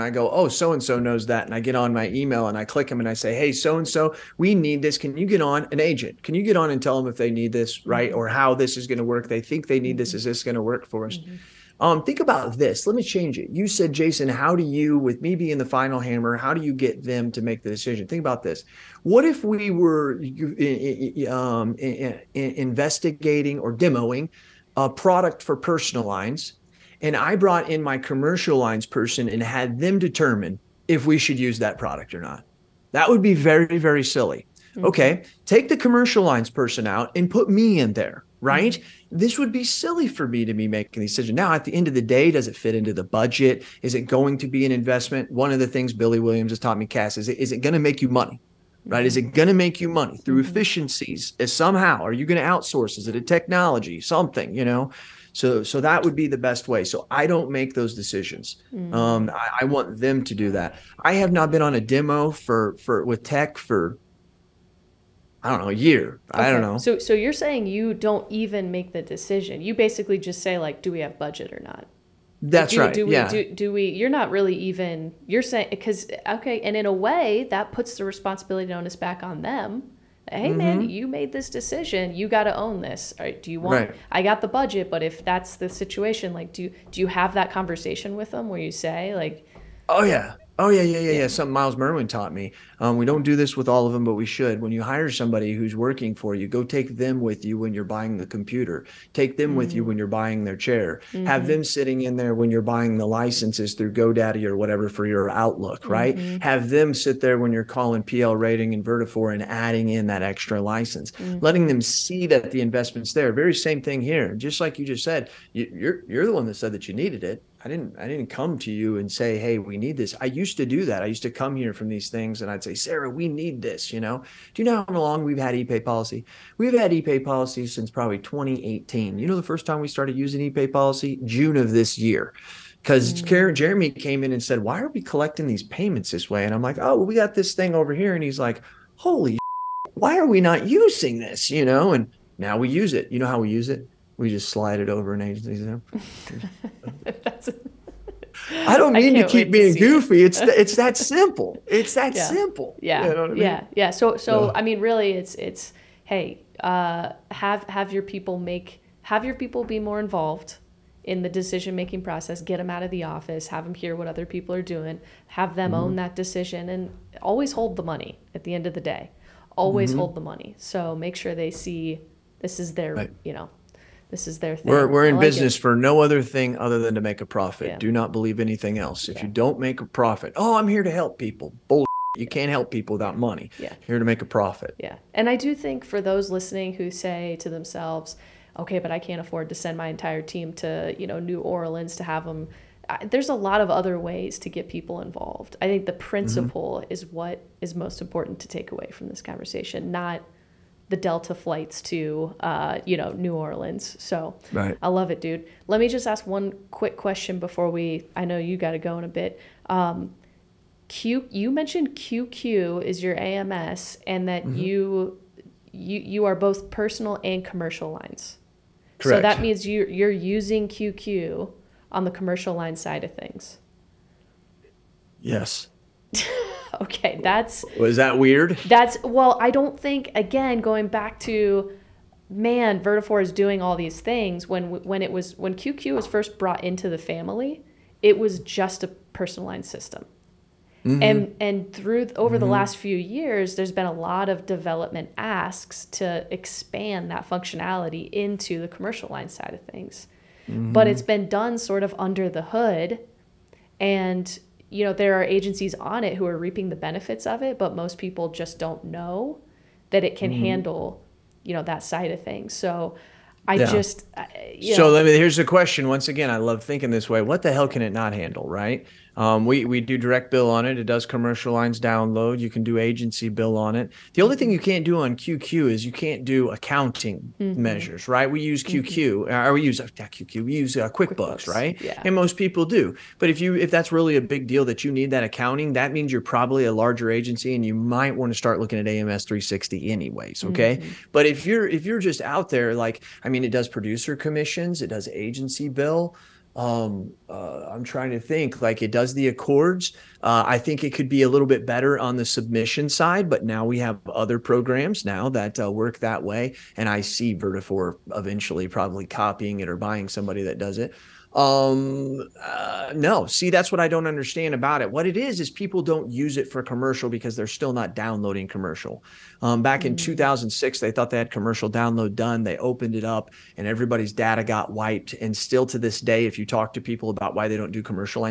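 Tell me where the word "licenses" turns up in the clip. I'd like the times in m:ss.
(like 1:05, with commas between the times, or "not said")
1:43, 1:50.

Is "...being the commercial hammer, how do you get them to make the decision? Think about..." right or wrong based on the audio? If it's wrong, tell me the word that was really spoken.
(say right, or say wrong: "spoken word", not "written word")
wrong: "final", not "commercial".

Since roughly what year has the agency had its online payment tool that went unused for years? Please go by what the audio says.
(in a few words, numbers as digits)
2018.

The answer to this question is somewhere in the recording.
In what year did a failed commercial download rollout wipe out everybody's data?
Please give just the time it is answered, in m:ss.
5:20.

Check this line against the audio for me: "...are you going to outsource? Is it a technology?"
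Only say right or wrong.
right.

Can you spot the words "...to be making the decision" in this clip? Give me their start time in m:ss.
0:40.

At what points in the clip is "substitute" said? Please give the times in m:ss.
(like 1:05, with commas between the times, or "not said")
not said.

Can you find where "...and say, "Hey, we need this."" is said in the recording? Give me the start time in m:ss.
1:58.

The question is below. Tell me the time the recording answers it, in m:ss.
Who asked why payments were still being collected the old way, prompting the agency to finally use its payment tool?
2:13.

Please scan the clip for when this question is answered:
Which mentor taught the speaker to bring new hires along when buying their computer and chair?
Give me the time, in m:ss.
1:31.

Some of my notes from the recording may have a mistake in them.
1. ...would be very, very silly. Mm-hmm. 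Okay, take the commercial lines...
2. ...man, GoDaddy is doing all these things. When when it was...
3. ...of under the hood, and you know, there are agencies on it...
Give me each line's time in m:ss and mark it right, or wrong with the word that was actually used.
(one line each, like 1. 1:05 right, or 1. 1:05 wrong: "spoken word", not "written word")
1. 0:33 right
2. 3:52 wrong: "Vertafore", not "GoDaddy"
3. 4:11 right.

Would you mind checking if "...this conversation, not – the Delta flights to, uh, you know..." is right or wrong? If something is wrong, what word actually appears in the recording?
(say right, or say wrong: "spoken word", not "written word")
right.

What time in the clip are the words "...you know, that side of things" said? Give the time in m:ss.
4:21.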